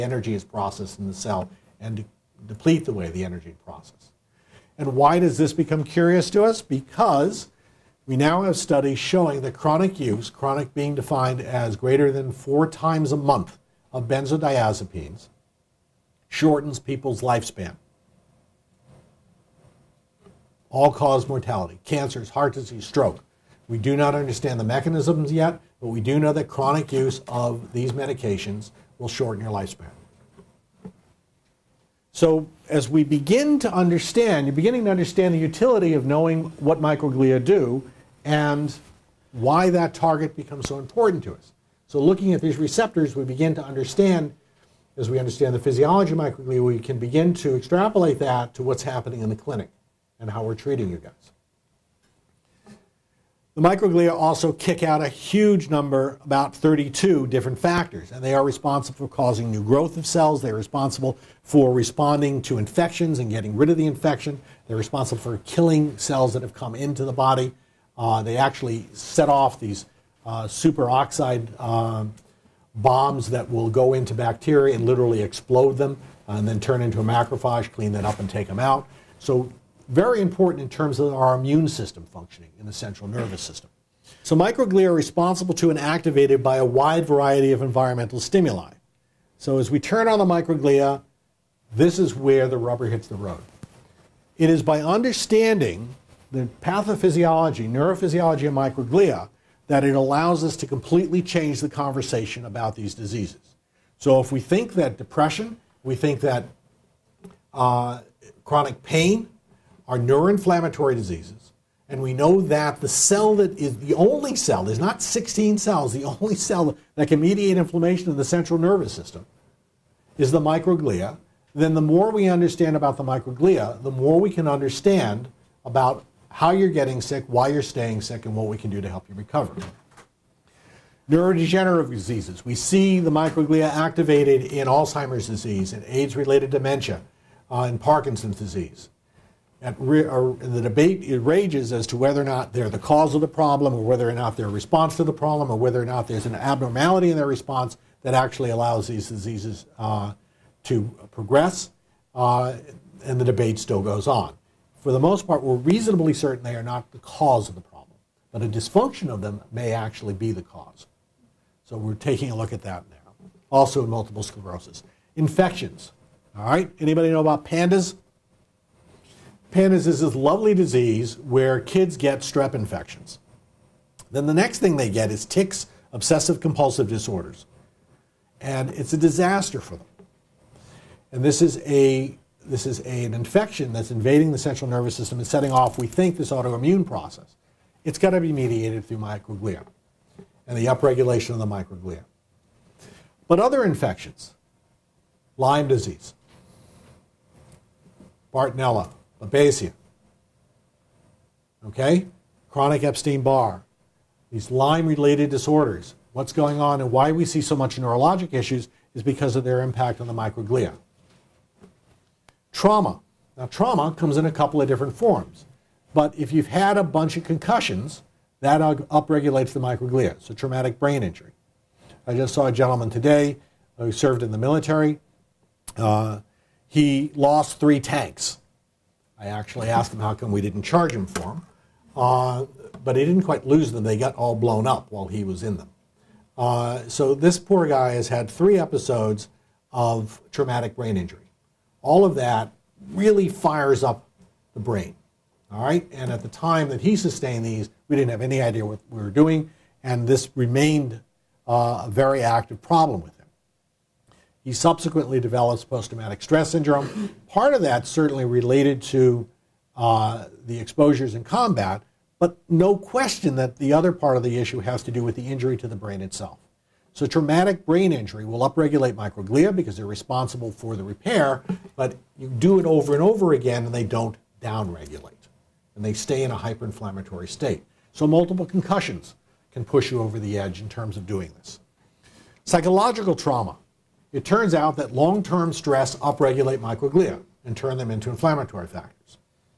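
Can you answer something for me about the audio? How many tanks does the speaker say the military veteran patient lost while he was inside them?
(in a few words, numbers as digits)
3.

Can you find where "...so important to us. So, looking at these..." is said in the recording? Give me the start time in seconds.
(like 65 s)
40 s.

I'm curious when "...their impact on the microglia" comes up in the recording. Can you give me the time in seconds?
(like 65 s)
209 s.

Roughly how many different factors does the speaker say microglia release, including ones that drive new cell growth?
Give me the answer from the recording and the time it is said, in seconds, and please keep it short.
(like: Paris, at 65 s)
32, at 56 s.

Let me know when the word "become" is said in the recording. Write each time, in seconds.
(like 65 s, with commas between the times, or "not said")
5 s, 40 s.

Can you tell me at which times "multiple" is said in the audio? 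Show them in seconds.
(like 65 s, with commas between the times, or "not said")
163 s, 278 s.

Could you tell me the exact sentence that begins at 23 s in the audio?
We do not understand the mechanisms yet, but we do know that chronic use of these medications will shorten your lifespan.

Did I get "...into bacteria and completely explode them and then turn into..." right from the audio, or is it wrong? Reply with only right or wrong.
wrong.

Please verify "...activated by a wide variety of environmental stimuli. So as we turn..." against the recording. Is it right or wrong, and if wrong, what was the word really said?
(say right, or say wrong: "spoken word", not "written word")
right.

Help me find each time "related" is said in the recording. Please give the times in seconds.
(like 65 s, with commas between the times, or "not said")
136 s, 204 s, 258 s.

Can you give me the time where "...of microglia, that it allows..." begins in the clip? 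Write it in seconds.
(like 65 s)
98 s.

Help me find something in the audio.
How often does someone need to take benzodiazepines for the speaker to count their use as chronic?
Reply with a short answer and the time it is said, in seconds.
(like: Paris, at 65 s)
More than 4 times a month, at 11 s.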